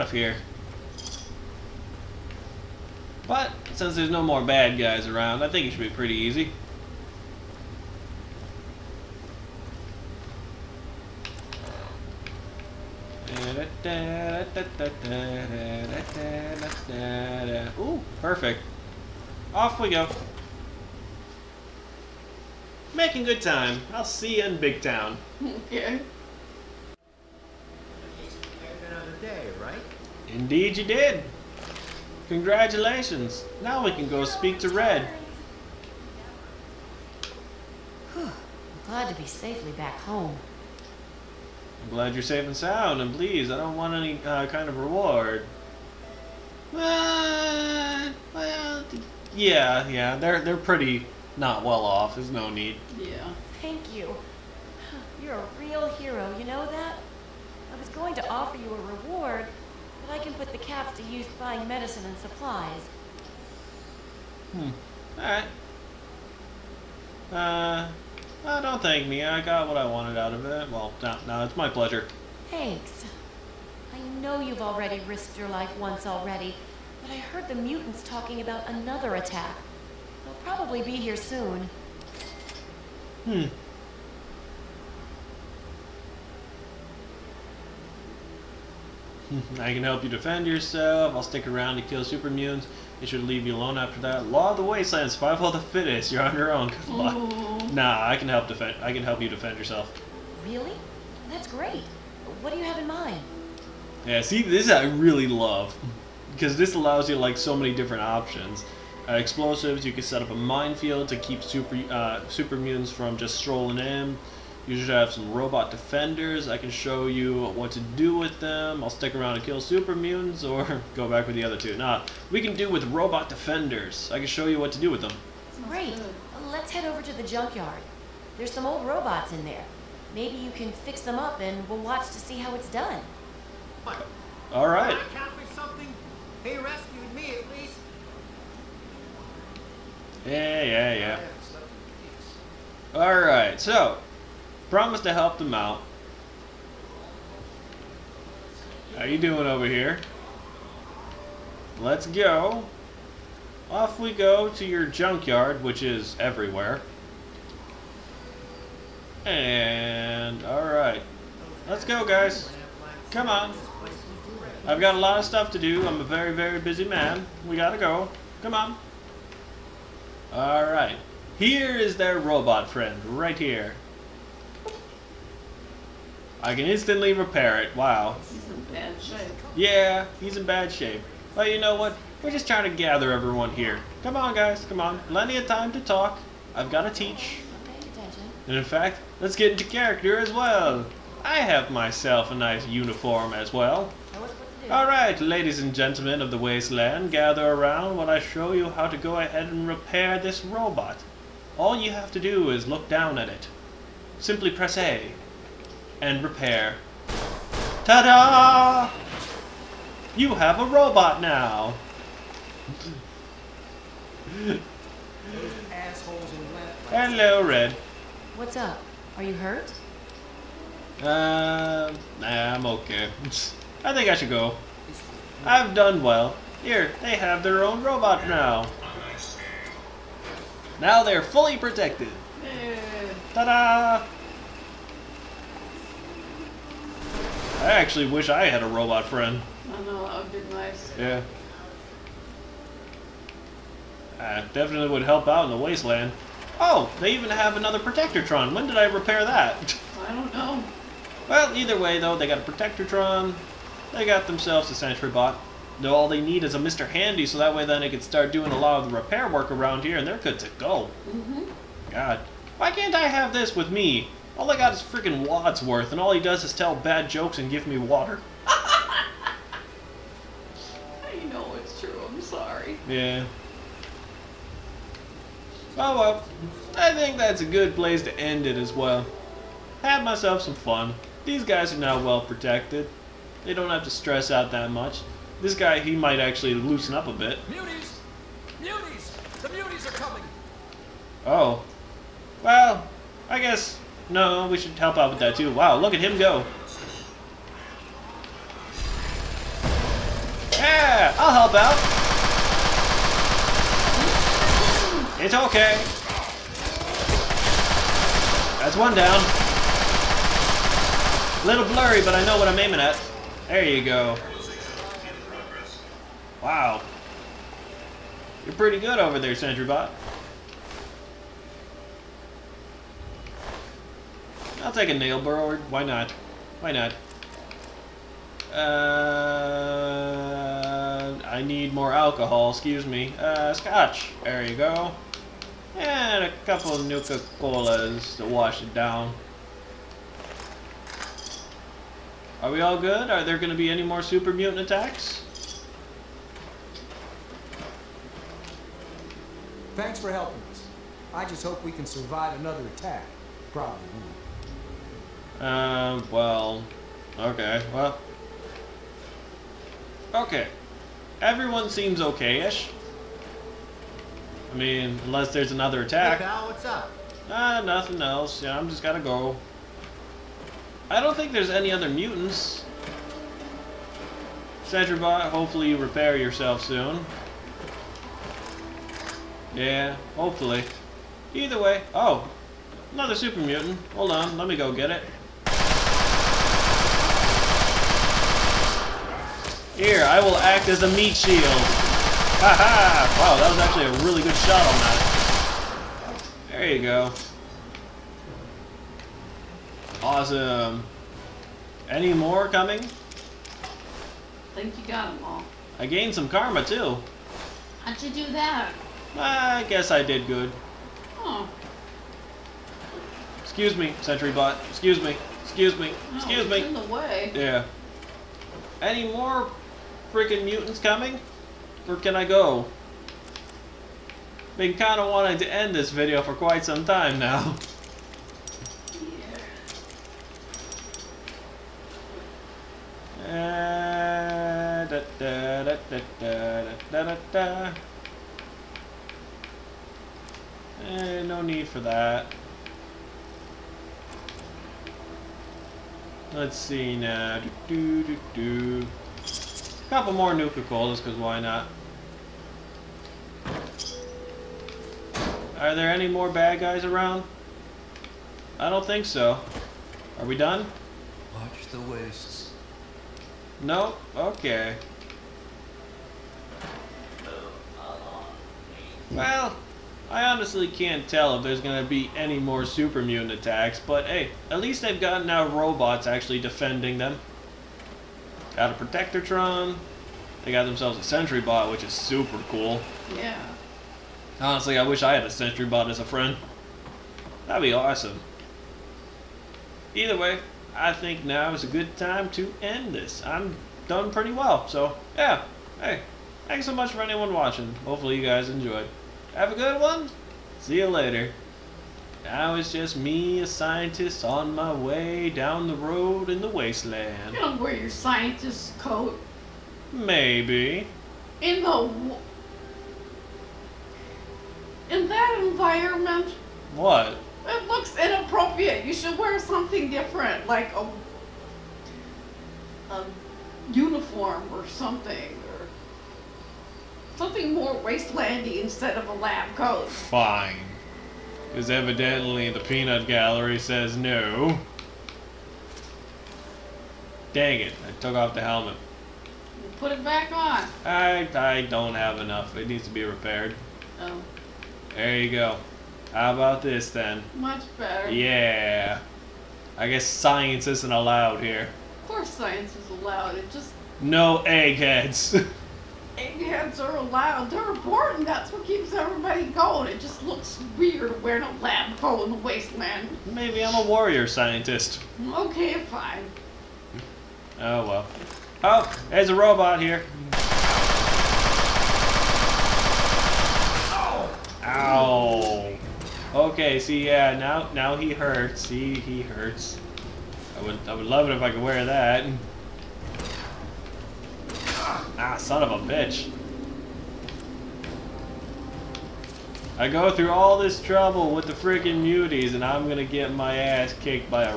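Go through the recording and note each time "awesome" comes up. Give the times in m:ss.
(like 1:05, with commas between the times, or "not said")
6:40, 8:07.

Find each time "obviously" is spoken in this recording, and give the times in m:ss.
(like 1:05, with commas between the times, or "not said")
not said.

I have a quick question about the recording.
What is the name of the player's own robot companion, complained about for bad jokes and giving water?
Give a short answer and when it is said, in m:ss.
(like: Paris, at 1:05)
Wadsworth, at 4:25.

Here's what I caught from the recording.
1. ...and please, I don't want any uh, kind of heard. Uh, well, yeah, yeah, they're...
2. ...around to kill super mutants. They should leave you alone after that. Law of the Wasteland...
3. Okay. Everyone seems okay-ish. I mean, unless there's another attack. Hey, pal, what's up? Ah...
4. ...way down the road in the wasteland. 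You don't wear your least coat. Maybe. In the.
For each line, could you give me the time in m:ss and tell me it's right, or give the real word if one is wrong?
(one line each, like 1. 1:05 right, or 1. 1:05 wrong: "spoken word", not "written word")
1. 0:43 wrong: "reward", not "heard"
2. 1:31 right
3. 6:00 right
4. 8:24 wrong: "scientist", not "least".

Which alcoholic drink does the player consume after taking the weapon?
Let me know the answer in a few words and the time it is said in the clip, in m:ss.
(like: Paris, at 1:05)
scotch, at 5:33.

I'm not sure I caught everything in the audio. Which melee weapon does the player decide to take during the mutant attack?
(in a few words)
nail board.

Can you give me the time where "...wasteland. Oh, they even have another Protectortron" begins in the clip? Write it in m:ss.
4:05.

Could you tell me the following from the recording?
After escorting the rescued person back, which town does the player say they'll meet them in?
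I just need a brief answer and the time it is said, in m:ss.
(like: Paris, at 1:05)
Big Town, at 0:24.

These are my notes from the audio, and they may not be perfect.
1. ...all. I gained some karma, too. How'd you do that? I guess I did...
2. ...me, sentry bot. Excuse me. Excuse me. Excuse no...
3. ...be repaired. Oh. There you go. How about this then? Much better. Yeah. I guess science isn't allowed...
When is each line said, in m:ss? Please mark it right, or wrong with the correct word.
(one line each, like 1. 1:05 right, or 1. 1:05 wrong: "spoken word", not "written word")
1. 6:45 right
2. 6:53 right
3. 9:02 right.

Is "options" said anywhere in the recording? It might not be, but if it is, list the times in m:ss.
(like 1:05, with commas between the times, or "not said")
1:48.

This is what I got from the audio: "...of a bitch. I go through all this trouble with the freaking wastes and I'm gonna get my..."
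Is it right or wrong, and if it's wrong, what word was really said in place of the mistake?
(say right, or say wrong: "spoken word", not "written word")
wrong: "muties", not "wastes".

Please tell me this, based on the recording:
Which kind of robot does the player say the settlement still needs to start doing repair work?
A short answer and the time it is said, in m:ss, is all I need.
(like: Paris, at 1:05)
Mr. Handy, at 4:16.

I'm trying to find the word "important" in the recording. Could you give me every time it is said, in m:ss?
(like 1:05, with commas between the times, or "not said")
9:17.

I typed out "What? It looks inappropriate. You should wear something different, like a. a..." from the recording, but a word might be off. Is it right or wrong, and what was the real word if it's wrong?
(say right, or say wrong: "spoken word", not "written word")
right.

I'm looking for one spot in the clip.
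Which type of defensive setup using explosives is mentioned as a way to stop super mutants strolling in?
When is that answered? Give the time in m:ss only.
1:50.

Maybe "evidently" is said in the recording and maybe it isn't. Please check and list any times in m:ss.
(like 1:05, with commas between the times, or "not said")
8:51.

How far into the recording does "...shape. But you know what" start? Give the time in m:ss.
3:00.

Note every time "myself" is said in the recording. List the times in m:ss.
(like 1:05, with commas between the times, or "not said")
3:11, 4:40.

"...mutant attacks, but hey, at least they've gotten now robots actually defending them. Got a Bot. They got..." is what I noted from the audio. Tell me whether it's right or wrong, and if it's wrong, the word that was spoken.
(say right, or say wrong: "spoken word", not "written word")
wrong: "Protectortron", not "Bot".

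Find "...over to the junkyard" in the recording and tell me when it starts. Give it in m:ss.
2:06.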